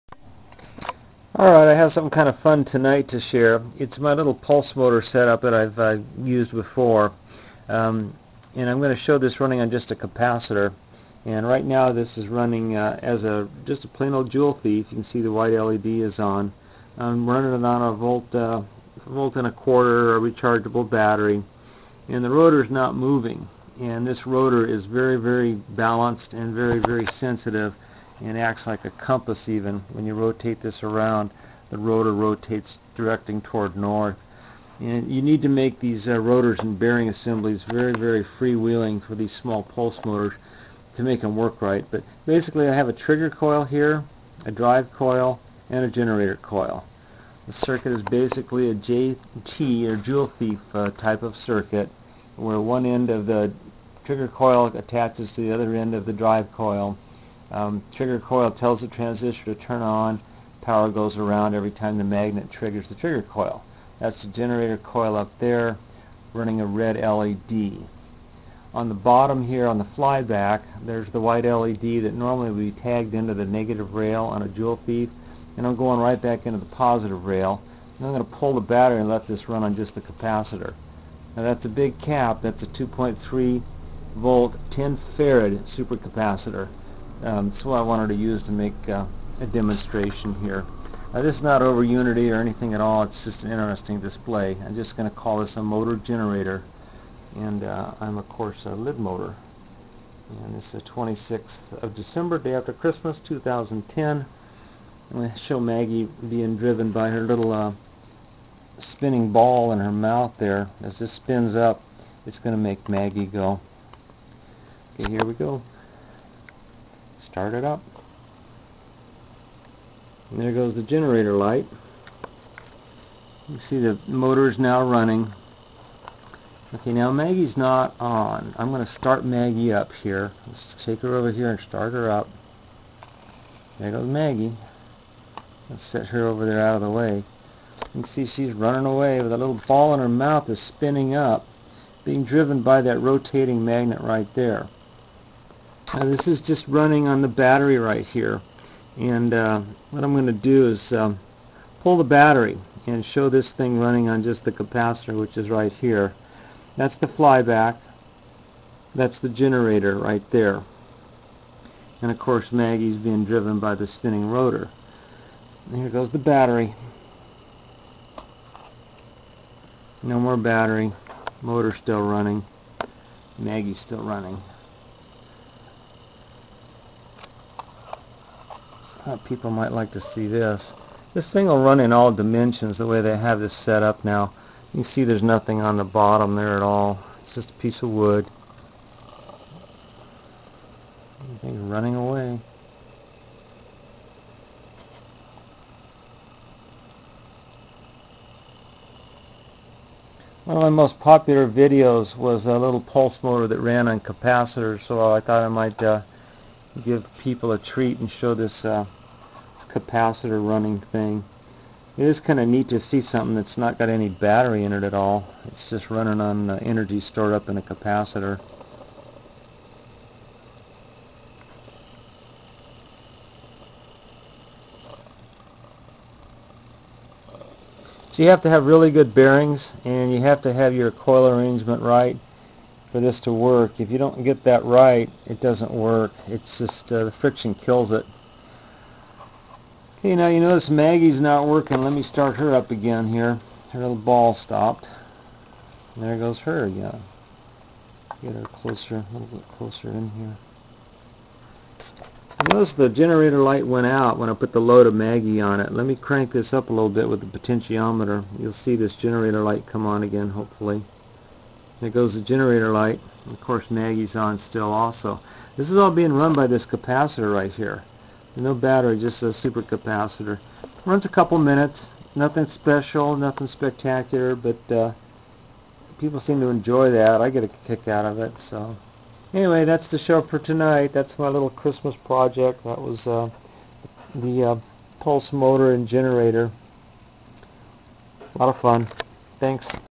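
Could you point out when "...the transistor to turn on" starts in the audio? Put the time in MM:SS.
00:58.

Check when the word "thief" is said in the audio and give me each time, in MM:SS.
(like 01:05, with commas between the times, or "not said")
00:14, 00:50.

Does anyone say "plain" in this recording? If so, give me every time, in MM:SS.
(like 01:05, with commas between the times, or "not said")
00:13.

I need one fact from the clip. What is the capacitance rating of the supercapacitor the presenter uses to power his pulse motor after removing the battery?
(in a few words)
10 farad.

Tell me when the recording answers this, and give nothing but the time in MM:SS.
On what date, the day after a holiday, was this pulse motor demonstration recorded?
01:40.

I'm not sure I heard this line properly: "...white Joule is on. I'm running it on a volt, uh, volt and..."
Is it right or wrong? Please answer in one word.
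wrong.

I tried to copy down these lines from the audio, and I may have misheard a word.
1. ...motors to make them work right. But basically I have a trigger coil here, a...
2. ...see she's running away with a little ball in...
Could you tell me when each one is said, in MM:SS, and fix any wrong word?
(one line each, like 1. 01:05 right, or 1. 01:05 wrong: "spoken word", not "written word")
1. 00:40 right
2. 02:18 right.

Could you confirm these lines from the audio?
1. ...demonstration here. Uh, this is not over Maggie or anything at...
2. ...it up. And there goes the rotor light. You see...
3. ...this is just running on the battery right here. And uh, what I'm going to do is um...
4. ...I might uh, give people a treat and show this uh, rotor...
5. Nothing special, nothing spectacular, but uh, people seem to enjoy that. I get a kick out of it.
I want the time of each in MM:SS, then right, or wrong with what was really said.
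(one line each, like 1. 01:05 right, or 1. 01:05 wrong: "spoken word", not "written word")
1. 01:29 wrong: "Unity", not "Maggie"
2. 01:57 wrong: "generator", not "rotor"
3. 02:26 right
4. 03:25 wrong: "capacitor", not "rotor"
5. 04:32 right.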